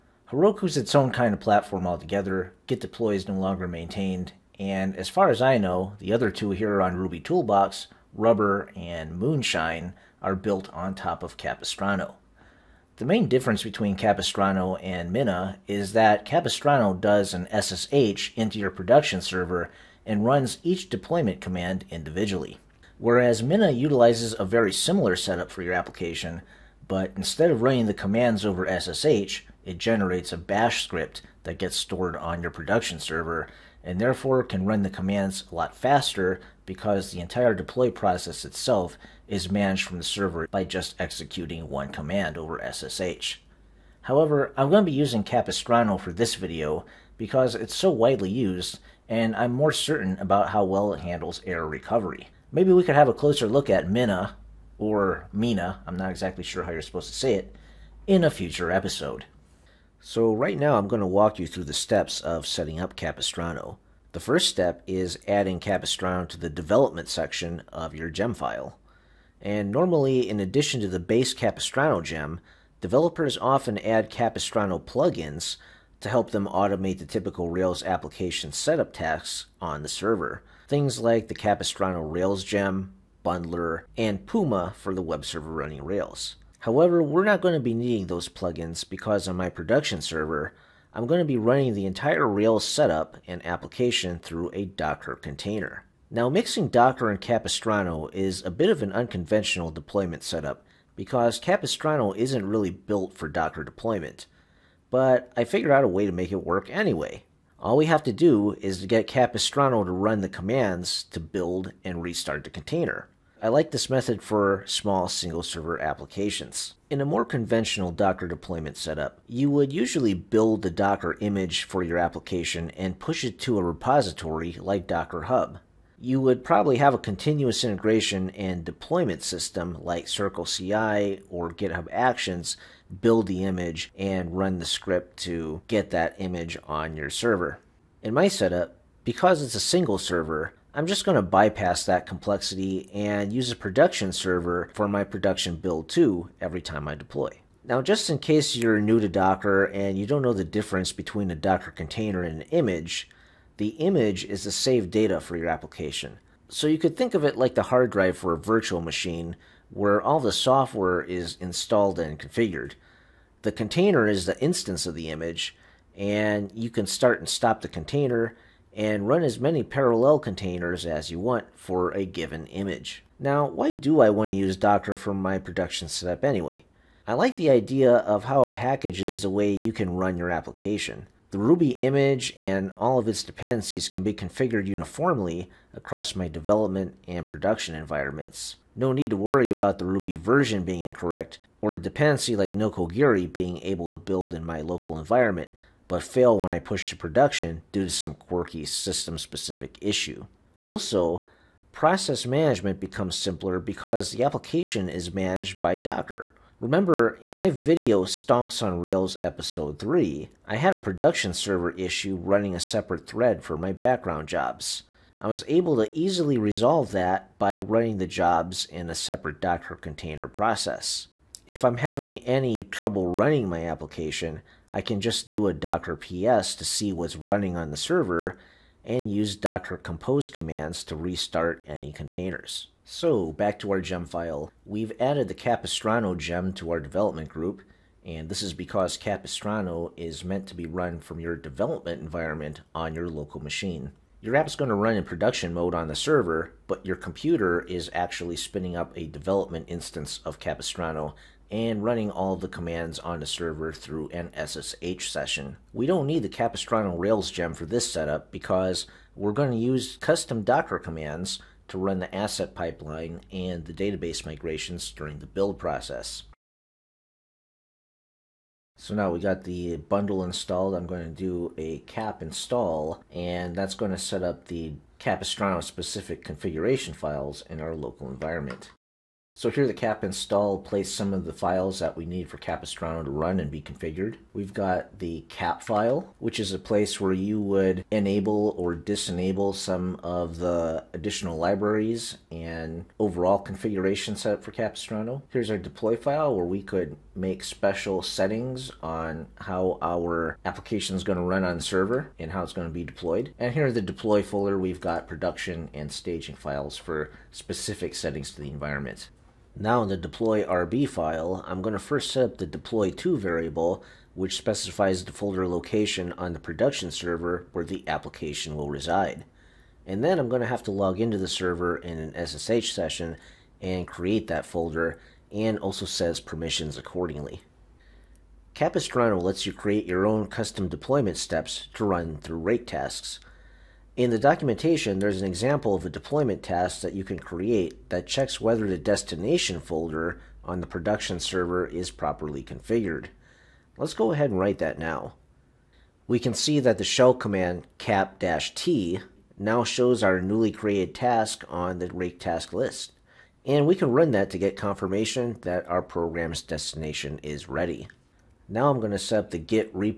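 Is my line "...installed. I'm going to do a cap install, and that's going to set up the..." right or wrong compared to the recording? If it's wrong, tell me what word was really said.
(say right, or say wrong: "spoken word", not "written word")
right.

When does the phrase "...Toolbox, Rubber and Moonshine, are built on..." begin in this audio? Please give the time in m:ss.
0:07.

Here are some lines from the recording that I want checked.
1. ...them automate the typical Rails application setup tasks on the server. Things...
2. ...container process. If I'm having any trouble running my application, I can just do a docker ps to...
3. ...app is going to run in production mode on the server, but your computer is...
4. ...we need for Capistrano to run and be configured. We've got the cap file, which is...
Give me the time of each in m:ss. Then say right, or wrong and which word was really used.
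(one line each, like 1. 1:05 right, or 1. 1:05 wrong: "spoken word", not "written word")
1. 1:16 right
2. 3:39 right
3. 4:04 right
4. 4:41 right.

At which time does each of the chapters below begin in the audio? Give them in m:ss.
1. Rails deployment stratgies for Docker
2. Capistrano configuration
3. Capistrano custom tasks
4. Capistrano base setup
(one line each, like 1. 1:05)
1. 1:35
2. 3:52
3. 5:27
4. 0:59.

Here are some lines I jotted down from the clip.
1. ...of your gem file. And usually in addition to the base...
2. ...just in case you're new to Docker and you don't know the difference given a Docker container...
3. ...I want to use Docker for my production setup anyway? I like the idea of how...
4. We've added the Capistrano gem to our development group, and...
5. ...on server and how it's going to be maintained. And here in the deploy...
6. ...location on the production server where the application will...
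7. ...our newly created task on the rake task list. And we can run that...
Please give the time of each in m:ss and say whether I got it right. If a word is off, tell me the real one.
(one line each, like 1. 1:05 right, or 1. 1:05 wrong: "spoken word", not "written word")
1. 1:07 wrong: "normally", not "usually"
2. 2:27 wrong: "between", not "given"
3. 2:54 right
4. 3:54 right
5. 5:01 wrong: "deployed", not "maintained"
6. 5:15 right
7. 5:50 right.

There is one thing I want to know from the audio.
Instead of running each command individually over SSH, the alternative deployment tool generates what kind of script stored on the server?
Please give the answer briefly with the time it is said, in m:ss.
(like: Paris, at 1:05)
bash script, at 0:30.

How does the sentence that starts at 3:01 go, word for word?
The Ruby image and all of its dependencies can be configured uniformly across my development and production environments.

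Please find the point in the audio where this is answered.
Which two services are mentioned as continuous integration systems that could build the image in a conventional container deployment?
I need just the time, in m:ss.
2:10.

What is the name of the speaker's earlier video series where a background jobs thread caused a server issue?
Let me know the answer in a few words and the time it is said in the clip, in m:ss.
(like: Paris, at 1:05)
Stonks on Rails, at 3:28.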